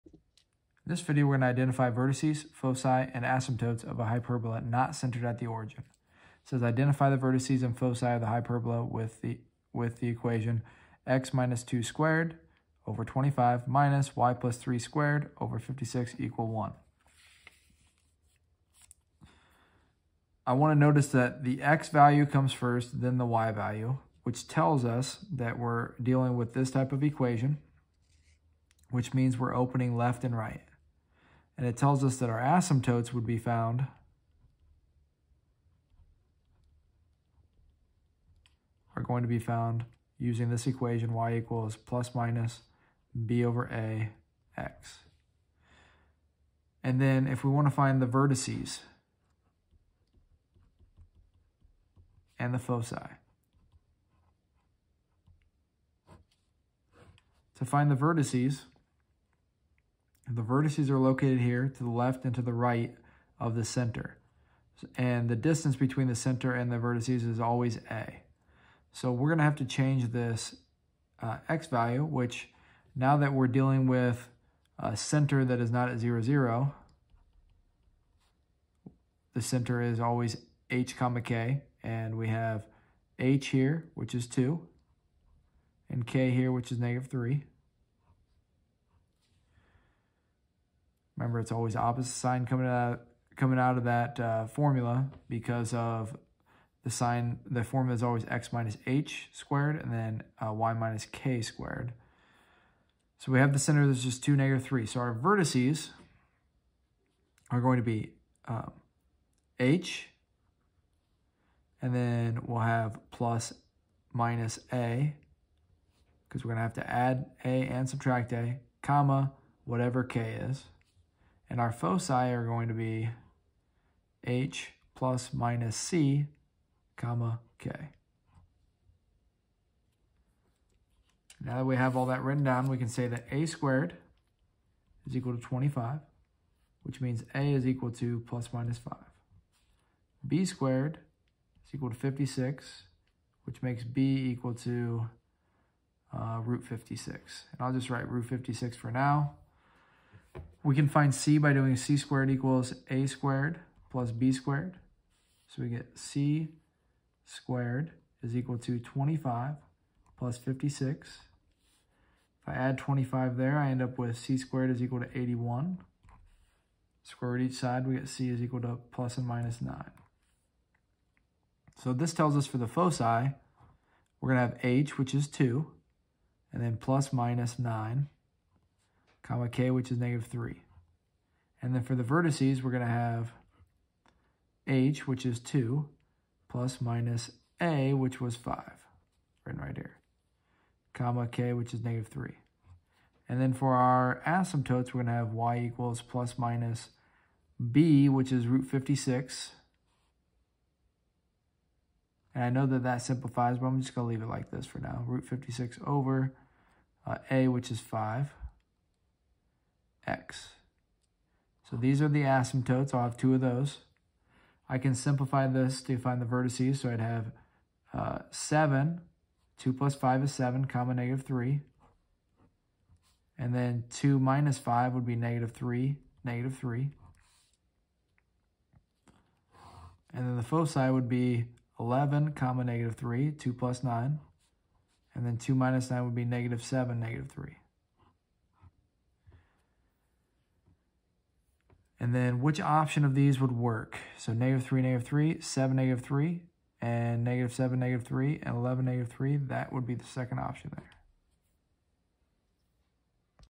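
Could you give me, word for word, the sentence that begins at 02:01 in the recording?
And our foci are going to be h plus minus c, comma, k.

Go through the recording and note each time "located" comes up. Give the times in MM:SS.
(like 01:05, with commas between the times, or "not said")
01:00.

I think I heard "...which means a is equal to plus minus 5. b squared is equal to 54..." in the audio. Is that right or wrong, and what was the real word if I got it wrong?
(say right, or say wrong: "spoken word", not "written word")
wrong: "56", not "54".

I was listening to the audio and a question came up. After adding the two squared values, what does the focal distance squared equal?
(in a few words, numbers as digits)
81.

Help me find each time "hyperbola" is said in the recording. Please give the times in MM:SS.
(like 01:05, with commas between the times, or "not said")
00:04, 00:08.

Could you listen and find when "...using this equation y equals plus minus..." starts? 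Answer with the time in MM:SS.
00:40.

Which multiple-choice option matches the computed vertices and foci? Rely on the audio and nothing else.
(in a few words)
The second option.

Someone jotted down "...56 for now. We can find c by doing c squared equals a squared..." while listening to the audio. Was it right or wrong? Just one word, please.
right.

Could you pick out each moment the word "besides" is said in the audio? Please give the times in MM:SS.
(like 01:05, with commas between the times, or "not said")
not said.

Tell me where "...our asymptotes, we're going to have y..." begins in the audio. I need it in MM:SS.
03:13.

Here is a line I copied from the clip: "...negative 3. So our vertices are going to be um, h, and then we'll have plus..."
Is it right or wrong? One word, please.
right.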